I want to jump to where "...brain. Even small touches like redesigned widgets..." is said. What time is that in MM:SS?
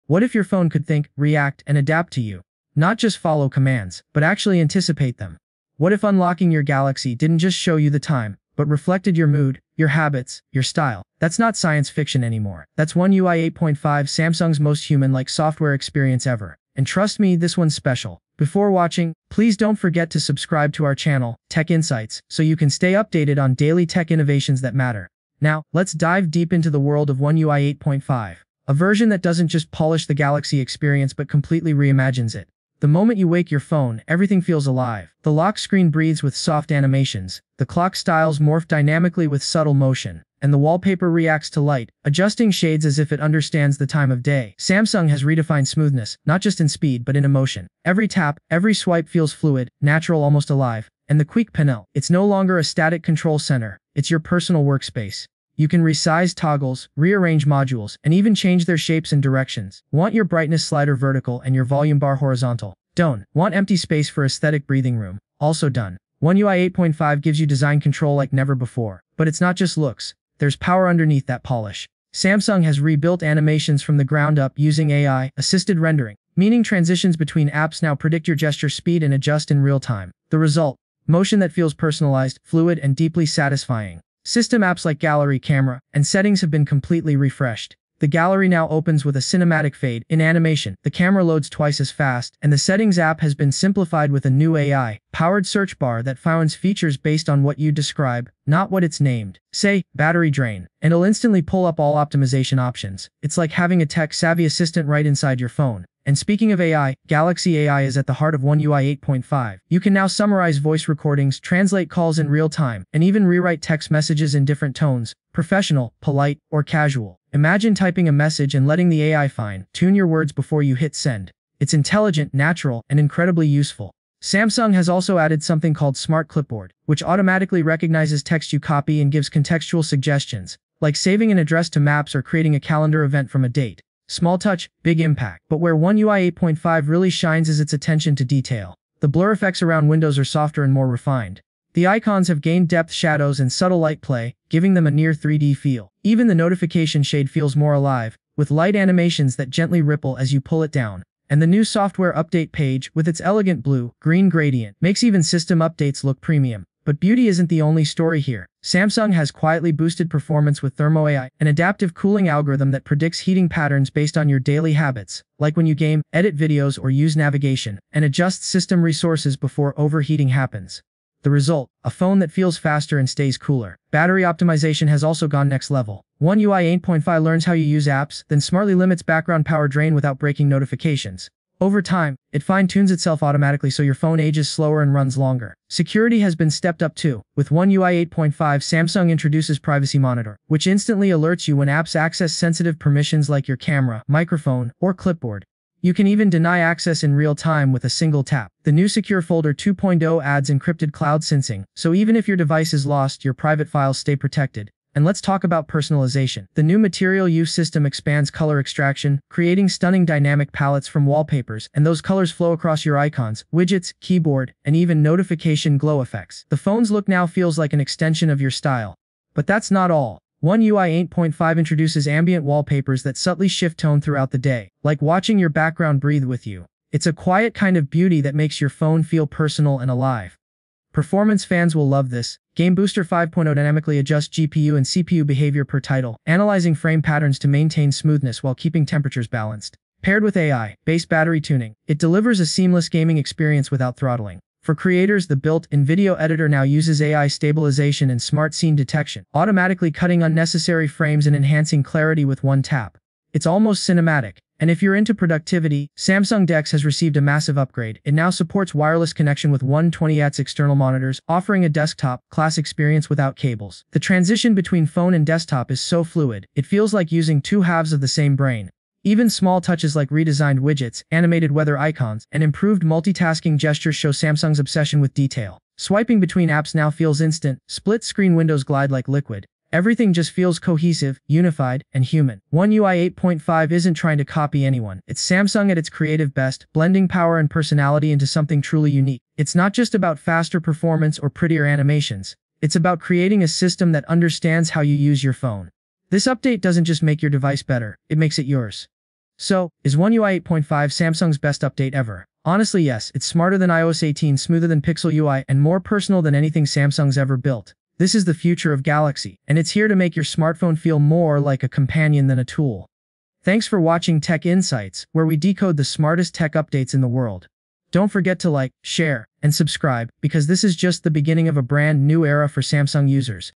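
04:28.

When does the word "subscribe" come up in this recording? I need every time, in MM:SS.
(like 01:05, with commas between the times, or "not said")
00:20, 05:19.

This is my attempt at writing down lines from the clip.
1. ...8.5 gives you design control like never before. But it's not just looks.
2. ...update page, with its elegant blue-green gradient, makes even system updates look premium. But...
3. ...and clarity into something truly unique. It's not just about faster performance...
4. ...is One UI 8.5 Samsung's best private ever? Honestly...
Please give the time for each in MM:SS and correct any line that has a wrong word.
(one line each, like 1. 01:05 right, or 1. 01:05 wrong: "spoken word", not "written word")
1. 01:06 right
2. 02:32 right
3. 04:47 wrong: "personality", not "clarity"
4. 04:59 wrong: "update", not "private".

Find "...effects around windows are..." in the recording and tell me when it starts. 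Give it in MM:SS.
02:19.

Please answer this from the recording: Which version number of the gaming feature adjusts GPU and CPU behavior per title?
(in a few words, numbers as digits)
5.0.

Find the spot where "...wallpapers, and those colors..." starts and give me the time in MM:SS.
03:31.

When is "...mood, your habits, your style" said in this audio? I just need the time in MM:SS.
00:09.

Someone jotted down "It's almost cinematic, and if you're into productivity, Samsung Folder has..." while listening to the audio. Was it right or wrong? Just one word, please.
wrong.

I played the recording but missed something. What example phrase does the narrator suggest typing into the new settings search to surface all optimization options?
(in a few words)
battery drain.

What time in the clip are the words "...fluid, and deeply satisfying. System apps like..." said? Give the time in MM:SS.
01:22.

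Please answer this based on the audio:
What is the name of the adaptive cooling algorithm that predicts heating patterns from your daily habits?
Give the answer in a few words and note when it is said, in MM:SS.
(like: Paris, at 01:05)
Thermo AI, at 02:40.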